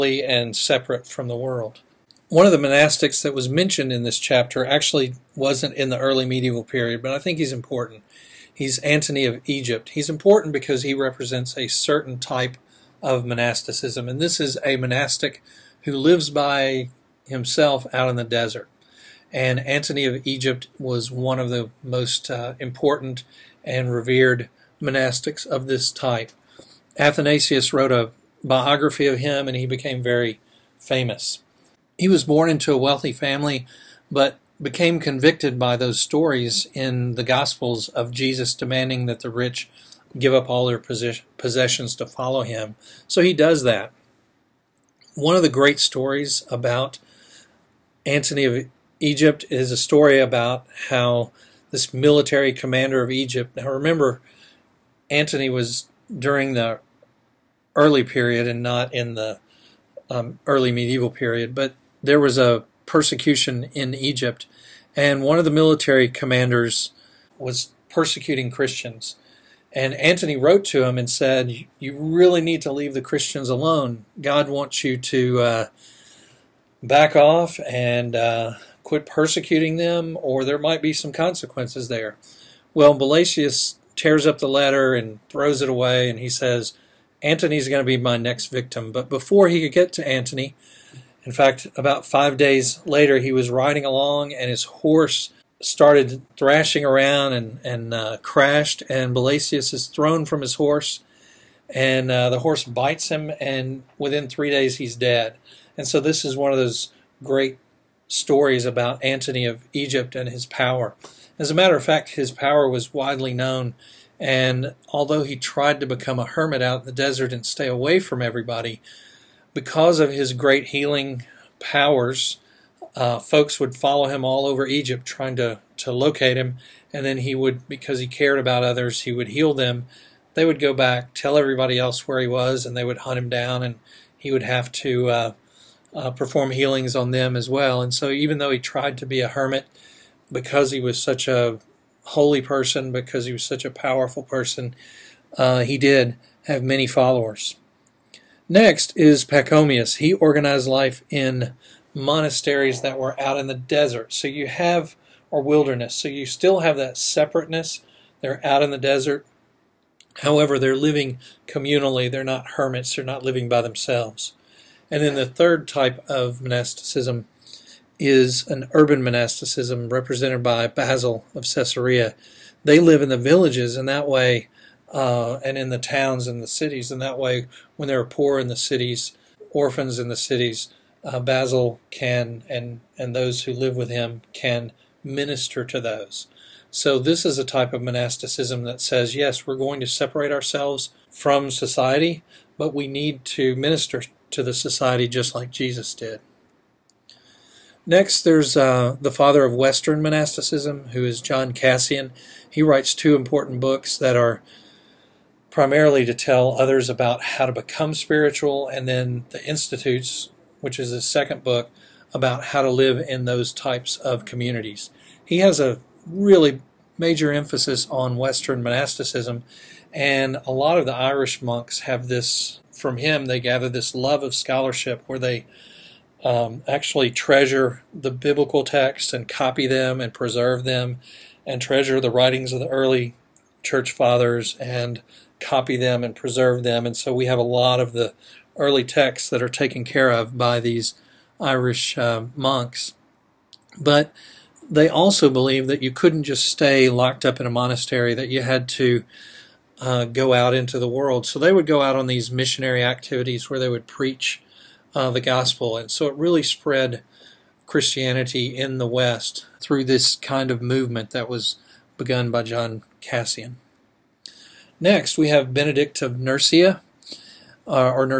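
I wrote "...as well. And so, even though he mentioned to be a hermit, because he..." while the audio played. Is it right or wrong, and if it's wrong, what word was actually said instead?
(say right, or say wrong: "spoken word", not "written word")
wrong: "tried", not "mentioned".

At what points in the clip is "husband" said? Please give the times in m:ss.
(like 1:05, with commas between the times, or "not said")
not said.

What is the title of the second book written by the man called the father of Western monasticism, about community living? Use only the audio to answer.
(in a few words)
the Institutes.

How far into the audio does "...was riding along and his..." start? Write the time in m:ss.
1:33.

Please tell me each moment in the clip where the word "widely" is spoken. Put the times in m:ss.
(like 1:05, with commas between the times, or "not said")
1:52.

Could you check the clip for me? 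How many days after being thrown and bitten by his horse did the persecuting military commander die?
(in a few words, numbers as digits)
3.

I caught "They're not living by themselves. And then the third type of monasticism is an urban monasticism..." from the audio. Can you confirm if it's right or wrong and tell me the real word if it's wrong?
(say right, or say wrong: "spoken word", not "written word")
right.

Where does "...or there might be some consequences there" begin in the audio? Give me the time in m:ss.
1:20.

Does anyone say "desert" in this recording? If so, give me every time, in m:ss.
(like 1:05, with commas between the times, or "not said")
0:18, 1:56, 2:33, 2:38.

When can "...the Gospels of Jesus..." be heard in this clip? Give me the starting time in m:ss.
0:37.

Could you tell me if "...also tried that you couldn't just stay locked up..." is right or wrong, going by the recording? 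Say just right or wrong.
wrong.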